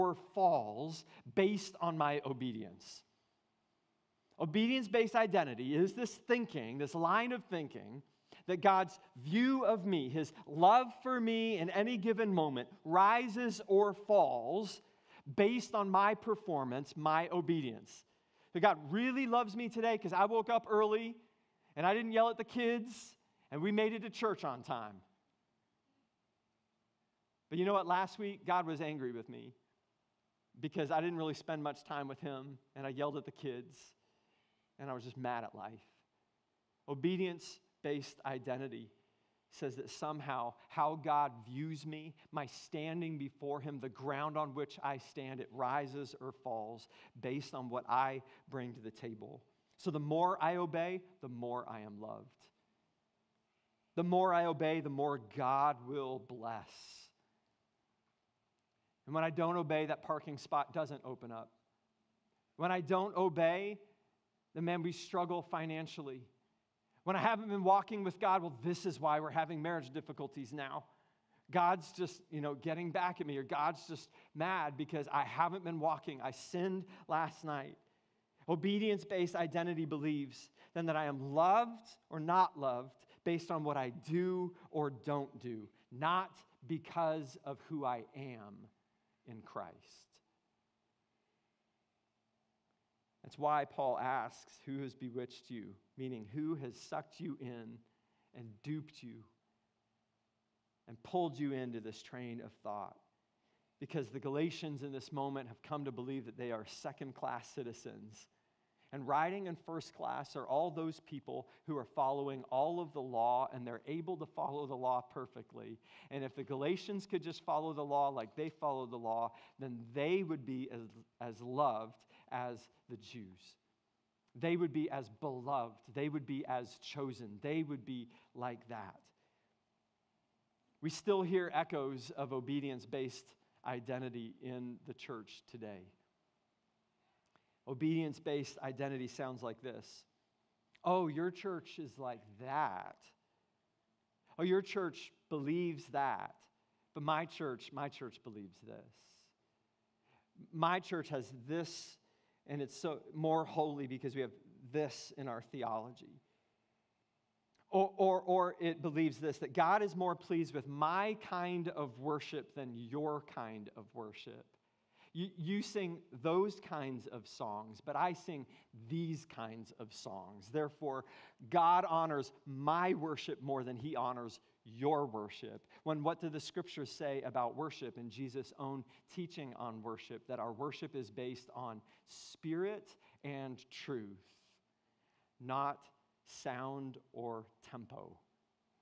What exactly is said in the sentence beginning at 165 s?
You, you sing those kinds of songs, but I sing these kinds of songs.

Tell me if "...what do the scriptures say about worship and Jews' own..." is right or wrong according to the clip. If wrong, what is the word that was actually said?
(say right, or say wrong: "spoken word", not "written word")
wrong: "Jesus", not "Jews".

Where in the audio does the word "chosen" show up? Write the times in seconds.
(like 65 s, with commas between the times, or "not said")
126 s.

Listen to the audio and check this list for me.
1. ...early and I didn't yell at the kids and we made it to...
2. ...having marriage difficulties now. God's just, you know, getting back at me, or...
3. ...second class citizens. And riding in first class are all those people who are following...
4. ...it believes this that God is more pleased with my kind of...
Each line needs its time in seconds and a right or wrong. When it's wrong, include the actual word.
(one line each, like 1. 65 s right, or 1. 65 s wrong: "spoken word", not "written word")
1. 20 s right
2. 69 s right
3. 106 s right
4. 158 s right.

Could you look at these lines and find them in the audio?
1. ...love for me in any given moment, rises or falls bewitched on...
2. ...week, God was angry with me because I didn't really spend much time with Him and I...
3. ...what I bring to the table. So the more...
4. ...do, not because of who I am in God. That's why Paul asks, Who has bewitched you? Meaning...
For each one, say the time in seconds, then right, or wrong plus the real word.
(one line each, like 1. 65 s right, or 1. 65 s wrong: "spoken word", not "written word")
1. 10 s wrong: "based", not "bewitched"
2. 28 s right
3. 47 s right
4. 85 s wrong: "Christ", not "God".